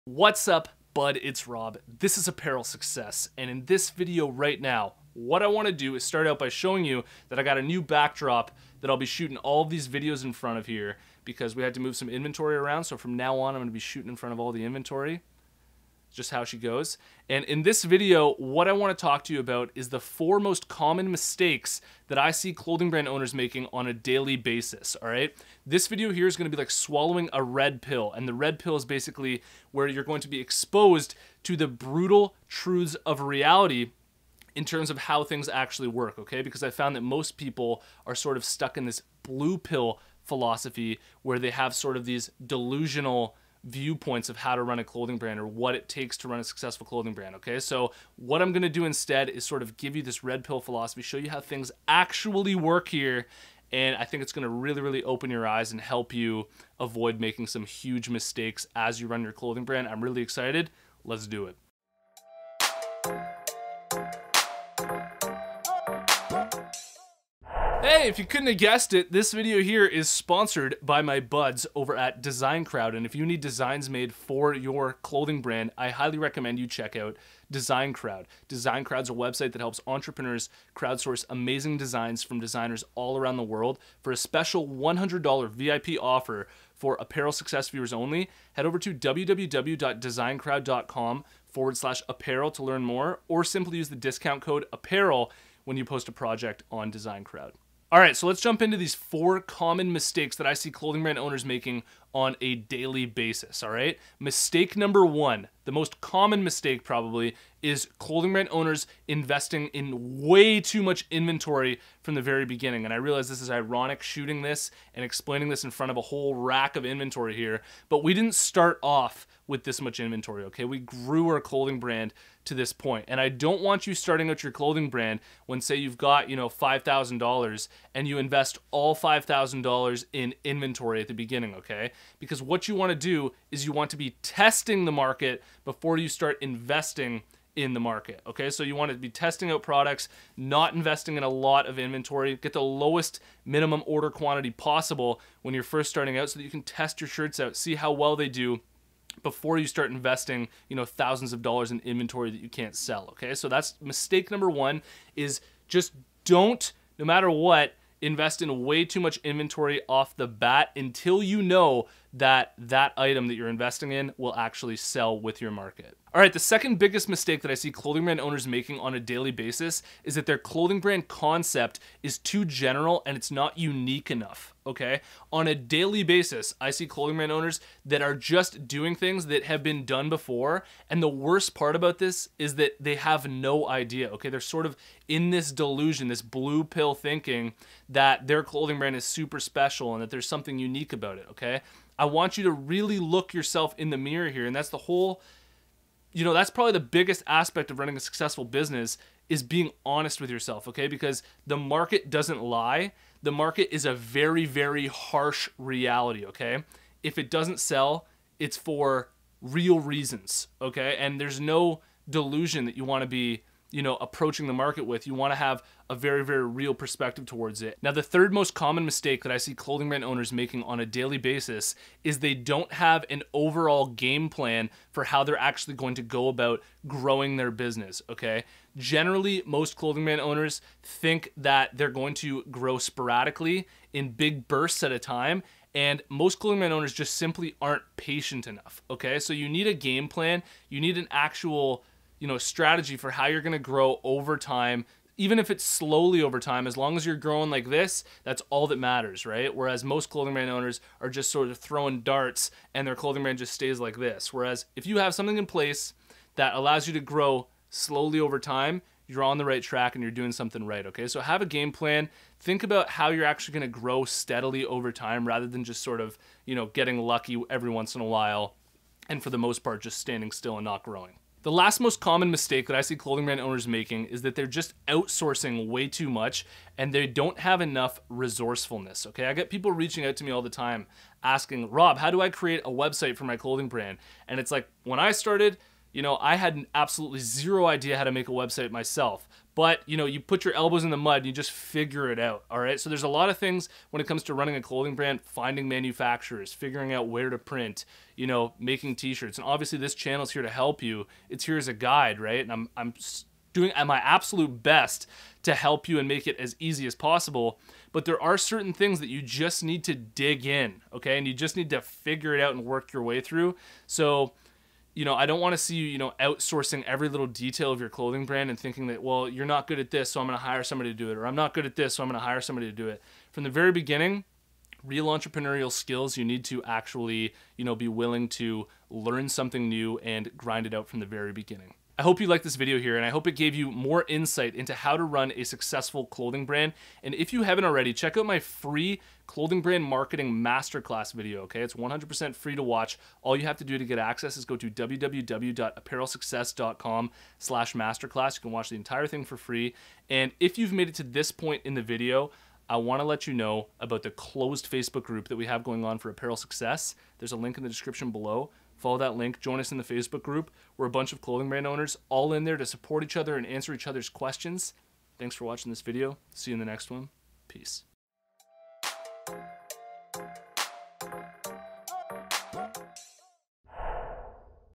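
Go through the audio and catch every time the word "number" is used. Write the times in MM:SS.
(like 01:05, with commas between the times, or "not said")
01:44, 02:34.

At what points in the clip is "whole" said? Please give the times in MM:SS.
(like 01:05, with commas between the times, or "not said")
01:56, 03:14.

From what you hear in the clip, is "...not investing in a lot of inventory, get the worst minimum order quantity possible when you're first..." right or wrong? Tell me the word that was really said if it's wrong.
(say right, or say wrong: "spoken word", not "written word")
wrong: "lowest", not "worst".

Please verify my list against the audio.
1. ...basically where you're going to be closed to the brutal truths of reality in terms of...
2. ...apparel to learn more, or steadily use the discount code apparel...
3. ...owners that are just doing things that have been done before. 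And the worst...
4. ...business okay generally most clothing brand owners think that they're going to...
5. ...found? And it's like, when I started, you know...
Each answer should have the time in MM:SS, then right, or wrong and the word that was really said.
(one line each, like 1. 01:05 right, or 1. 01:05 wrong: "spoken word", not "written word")
1. 00:28 wrong: "exposed", not "closed"
2. 01:32 wrong: "simply", not "steadily"
3. 02:57 right
4. 03:47 right
5. 04:43 wrong: "brand", not "found".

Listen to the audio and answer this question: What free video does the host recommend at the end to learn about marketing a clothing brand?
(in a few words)
marketing masterclass.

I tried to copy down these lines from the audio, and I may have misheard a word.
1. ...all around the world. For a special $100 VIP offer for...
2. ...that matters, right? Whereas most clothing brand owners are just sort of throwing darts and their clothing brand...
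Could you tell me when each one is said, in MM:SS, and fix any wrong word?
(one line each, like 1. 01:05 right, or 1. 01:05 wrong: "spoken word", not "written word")
1. 01:22 right
2. 04:08 right.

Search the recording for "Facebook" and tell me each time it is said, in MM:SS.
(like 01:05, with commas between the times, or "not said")
05:54, 05:59.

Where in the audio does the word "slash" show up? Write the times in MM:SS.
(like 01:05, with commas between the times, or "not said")
01:31, 05:47.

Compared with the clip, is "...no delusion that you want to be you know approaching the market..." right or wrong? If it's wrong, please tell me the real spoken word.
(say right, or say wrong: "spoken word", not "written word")
right.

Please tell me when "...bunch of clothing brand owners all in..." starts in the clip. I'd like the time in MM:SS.
06:00.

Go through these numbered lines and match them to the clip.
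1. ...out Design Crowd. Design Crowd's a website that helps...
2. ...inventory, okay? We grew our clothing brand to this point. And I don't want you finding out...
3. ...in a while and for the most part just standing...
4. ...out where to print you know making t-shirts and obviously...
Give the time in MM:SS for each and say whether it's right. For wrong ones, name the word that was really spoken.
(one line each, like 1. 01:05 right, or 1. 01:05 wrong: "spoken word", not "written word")
1. 01:16 right
2. 01:59 wrong: "starting", not "finding"
3. 04:27 right
4. 04:56 right.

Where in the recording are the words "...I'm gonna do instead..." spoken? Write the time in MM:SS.
00:48.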